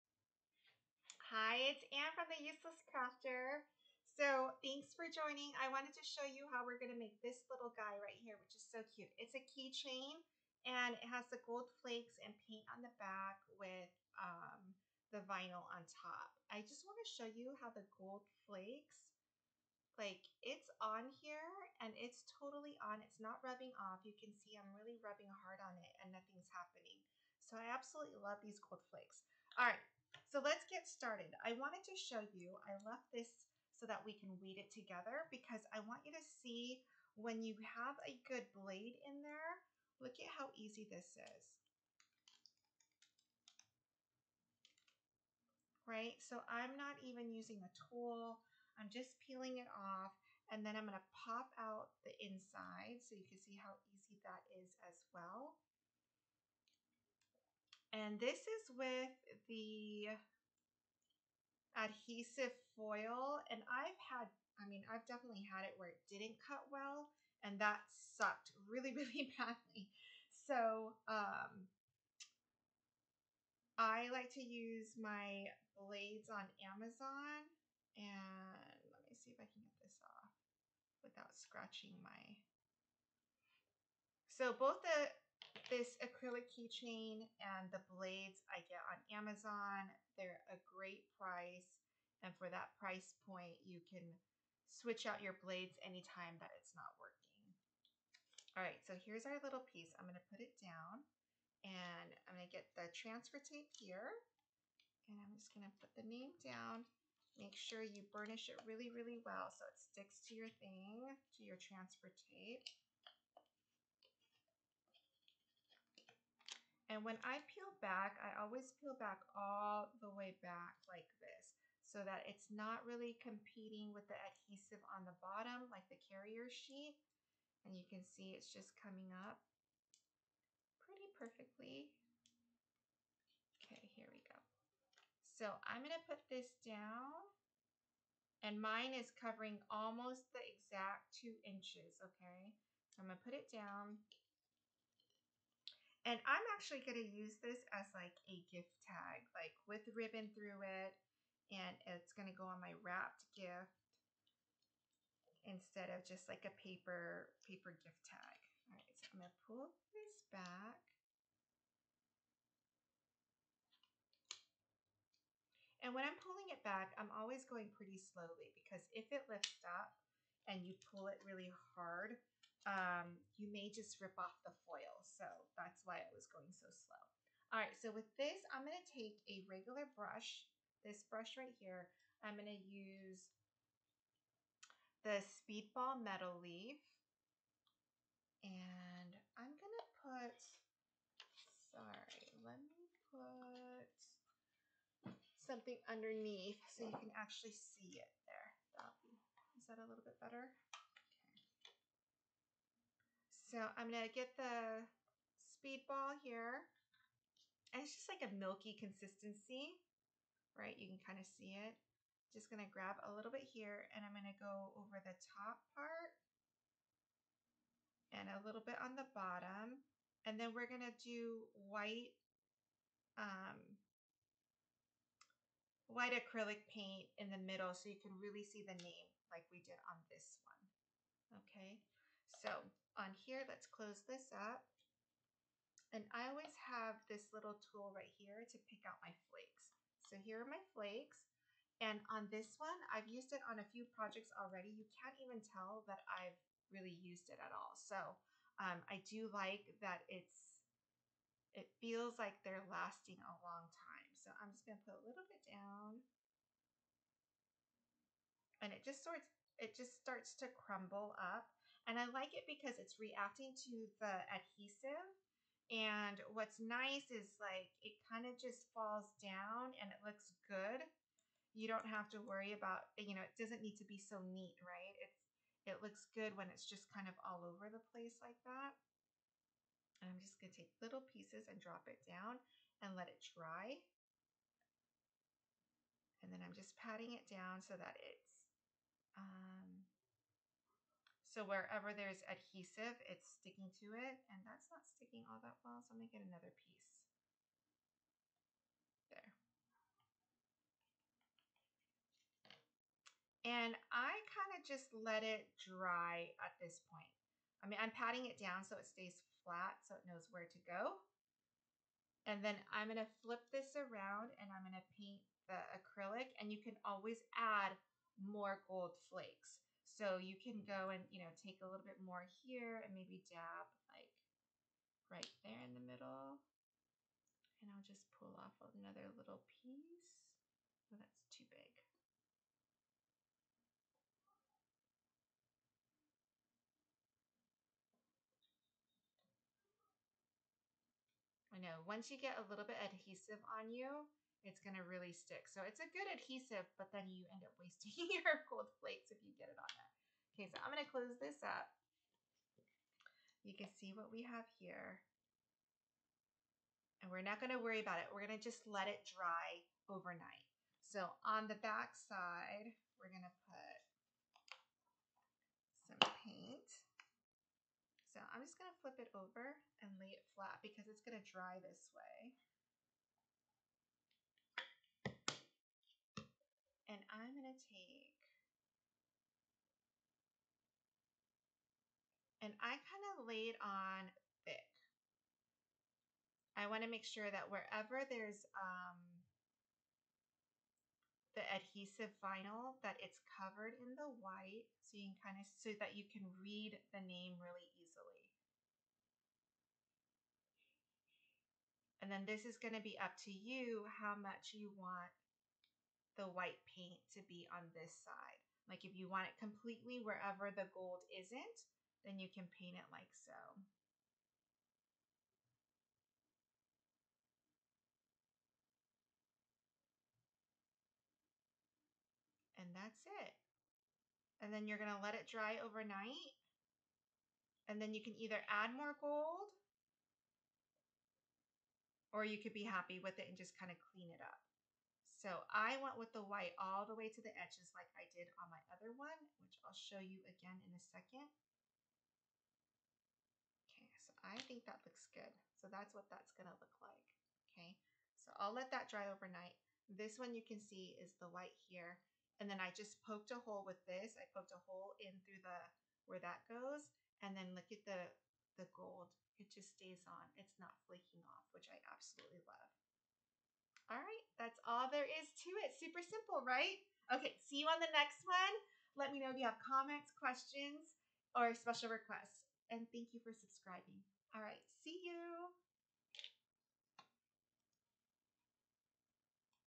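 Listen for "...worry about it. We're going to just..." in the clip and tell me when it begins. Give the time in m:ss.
5:57.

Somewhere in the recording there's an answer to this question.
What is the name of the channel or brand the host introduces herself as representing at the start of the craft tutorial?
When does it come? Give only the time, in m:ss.
0:02.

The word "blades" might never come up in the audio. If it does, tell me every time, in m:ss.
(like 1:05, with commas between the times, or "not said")
0:38, 1:15, 1:27, 1:35.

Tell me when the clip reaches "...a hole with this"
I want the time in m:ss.
7:33.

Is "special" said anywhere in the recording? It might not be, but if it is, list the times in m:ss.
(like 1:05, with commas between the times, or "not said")
7:51.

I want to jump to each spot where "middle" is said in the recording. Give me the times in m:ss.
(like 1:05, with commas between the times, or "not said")
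3:47, 5:25.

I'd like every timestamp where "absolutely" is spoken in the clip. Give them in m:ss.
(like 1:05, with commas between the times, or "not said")
0:27, 7:41.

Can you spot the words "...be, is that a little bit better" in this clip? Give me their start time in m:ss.
3:19.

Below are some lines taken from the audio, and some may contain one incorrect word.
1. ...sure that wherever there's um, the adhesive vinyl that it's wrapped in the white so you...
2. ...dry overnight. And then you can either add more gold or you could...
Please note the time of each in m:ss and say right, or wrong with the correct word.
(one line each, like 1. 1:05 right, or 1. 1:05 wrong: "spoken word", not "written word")
1. 6:27 wrong: "covered", not "wrapped"
2. 7:05 right.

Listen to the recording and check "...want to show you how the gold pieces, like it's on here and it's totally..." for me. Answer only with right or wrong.
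wrong.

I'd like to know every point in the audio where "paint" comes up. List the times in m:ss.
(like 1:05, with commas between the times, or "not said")
0:12, 3:46, 5:14, 6:06, 6:46, 6:52.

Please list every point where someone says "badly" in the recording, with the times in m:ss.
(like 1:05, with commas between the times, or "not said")
1:09.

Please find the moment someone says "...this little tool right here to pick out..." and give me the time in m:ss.
3:57.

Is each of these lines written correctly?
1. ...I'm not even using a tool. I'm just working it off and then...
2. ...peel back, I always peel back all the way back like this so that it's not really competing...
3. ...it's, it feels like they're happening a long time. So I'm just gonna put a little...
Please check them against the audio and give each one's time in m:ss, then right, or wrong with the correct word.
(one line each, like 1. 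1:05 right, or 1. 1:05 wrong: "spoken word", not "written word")
1. 0:46 wrong: "peeling", not "working"
2. 1:57 right
3. 4:10 wrong: "lasting", not "happening".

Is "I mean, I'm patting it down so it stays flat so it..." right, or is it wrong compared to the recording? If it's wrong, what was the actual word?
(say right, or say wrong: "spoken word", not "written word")
right.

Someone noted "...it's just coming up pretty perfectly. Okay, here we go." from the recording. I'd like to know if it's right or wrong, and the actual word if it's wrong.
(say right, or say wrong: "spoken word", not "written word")
right.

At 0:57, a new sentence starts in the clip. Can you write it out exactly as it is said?
And this is with the adhesive foil.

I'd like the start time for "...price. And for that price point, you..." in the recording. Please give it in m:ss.
1:31.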